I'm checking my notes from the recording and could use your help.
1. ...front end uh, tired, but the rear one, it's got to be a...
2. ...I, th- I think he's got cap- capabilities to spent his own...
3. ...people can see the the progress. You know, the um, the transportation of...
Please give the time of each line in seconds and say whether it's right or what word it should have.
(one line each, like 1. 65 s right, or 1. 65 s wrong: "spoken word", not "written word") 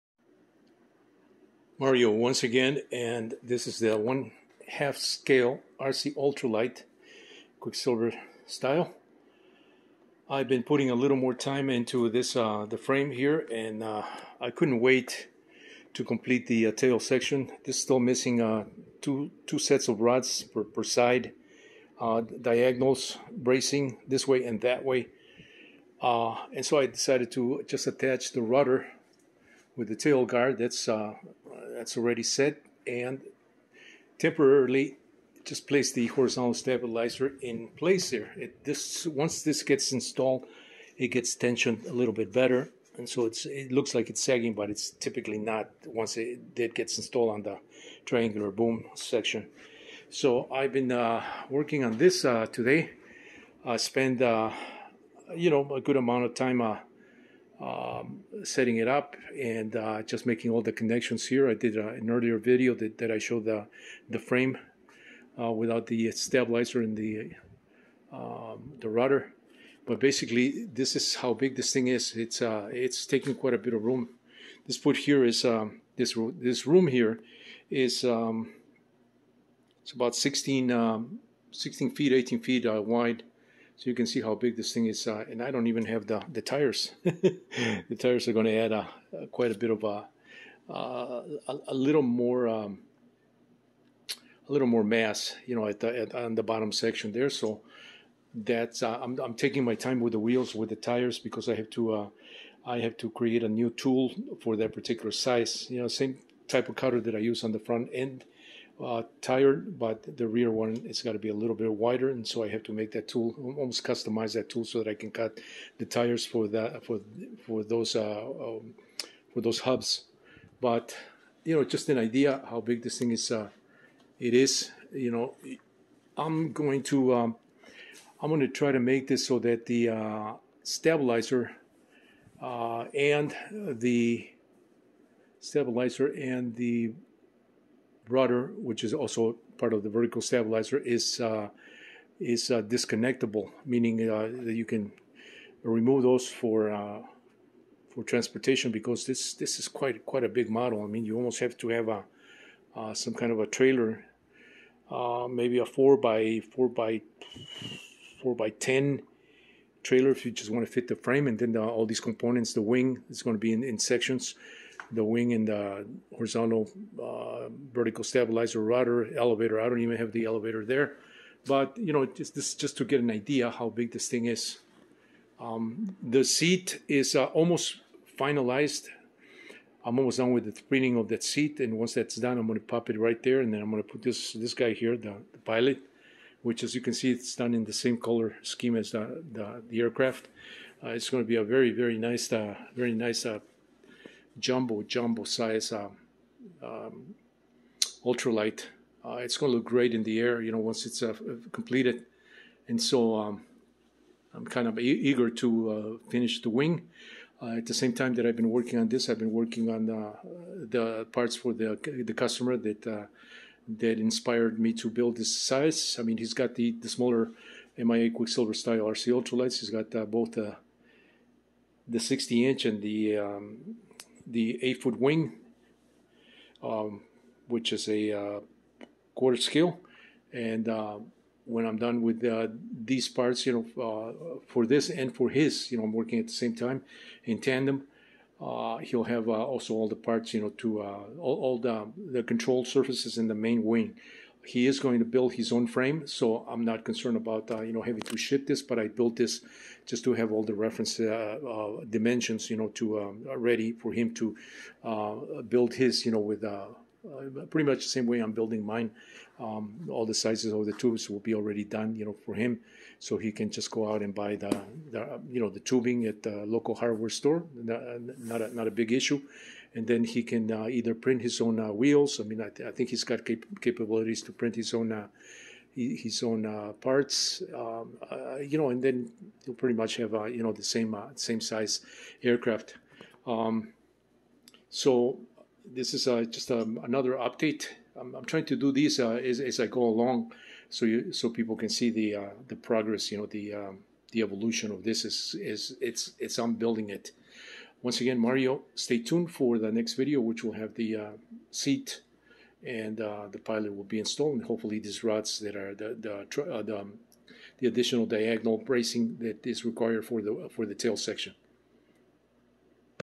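1. 107 s right
2. 272 s wrong: "print", not "spent"
3. 291 s wrong: "evolution", not "transportation".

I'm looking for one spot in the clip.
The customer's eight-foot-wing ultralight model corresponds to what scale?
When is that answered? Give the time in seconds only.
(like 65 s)
229 s.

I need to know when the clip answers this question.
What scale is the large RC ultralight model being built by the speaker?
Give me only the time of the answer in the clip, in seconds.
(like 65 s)
3 s.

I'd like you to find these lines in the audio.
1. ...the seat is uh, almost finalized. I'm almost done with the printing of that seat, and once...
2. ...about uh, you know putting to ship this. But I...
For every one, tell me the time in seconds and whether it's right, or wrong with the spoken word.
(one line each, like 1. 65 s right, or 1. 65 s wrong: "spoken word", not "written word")
1. 176 s right
2. 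247 s wrong: "having", not "putting".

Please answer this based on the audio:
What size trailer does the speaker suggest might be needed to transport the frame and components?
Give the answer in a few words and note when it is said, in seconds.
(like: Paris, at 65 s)
4 by 10, at 158 s.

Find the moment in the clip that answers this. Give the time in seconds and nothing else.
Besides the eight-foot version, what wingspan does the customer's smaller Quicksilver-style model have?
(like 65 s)
221 s.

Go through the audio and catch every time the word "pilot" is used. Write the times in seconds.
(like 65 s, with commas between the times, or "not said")
185 s, 303 s.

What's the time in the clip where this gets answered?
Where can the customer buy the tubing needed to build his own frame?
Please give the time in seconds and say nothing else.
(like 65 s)
266 s.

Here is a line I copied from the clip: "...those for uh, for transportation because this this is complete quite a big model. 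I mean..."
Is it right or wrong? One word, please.
wrong.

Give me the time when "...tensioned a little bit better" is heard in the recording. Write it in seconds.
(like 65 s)
41 s.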